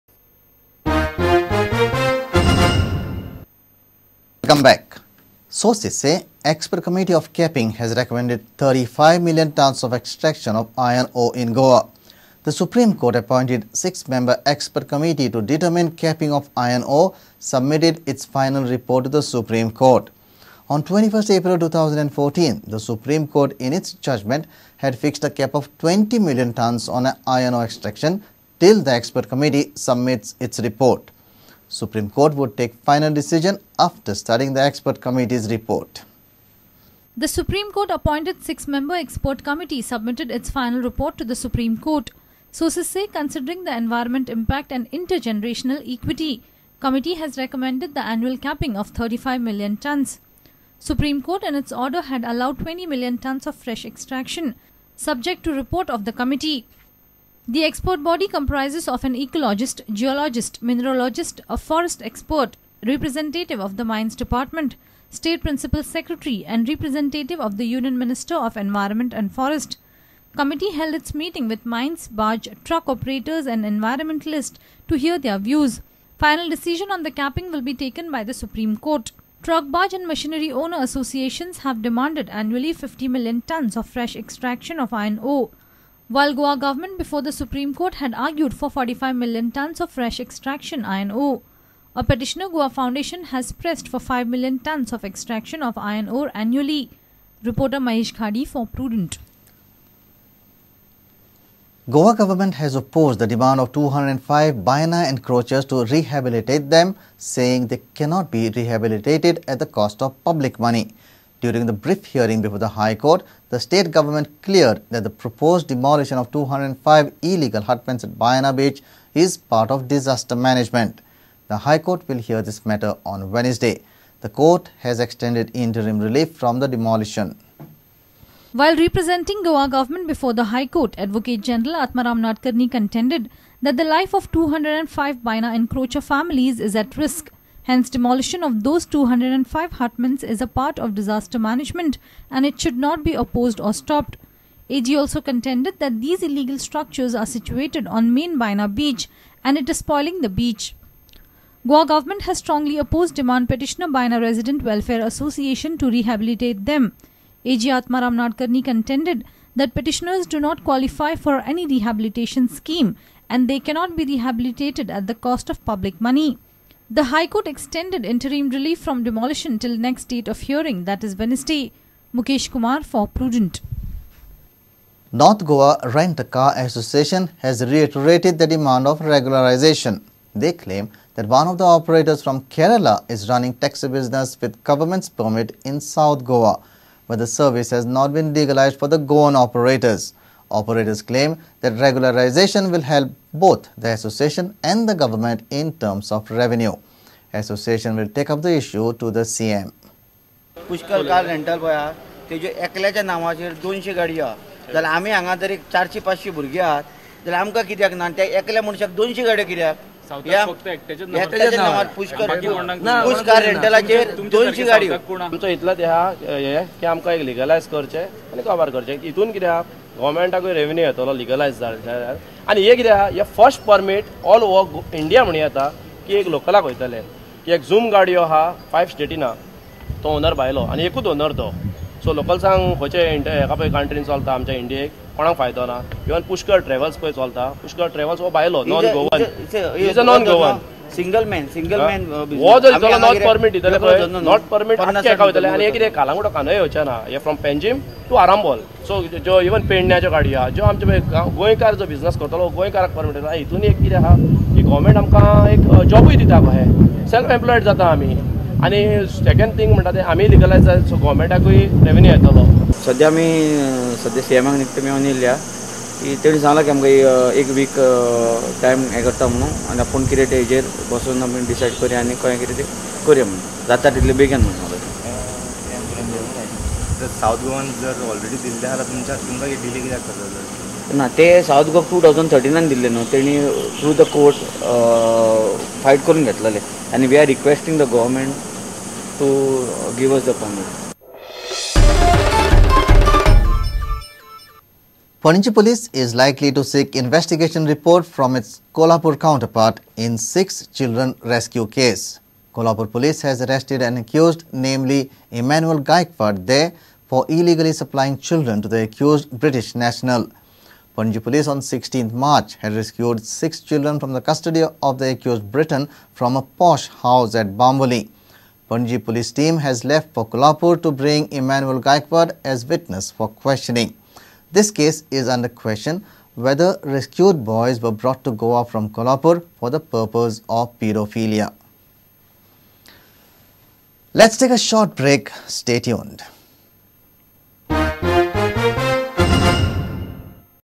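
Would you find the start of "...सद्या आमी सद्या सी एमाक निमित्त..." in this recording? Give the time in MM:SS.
04:22.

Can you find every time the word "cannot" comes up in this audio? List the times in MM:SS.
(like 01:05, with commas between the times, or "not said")
01:48, 02:43.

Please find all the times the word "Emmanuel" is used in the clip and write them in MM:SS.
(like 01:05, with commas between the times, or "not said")
05:05, 05:21.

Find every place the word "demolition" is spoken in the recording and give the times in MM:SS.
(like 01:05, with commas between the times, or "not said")
01:55, 02:06, 02:17, 02:49.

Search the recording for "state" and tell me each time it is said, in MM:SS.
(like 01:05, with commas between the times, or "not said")
01:05, 01:53.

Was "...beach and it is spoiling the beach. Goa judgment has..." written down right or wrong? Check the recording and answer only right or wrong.
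wrong.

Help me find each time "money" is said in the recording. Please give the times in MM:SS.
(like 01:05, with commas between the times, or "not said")
01:50, 02:46.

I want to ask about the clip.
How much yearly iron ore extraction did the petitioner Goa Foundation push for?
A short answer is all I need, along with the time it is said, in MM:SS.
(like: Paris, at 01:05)
5 million tons, at 01:34.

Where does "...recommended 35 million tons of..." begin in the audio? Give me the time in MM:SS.
00:07.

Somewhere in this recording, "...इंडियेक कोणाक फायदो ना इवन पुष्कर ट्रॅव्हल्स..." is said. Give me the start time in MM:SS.
03:54.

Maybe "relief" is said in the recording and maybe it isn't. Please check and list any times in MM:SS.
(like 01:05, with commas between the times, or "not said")
02:05, 02:48.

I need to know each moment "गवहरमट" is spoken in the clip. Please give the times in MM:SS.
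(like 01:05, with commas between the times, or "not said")
04:47.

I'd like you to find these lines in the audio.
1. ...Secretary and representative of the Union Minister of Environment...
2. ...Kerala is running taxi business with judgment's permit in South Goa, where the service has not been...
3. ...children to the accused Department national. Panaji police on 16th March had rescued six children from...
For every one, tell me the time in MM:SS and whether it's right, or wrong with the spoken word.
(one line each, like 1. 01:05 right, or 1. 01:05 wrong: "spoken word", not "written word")
1. 01:05 right
2. 03:02 wrong: "government", not "judgment"
3. 05:08 wrong: "British", not "Department".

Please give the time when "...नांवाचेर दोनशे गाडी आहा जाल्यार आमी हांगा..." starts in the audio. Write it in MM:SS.
03:23.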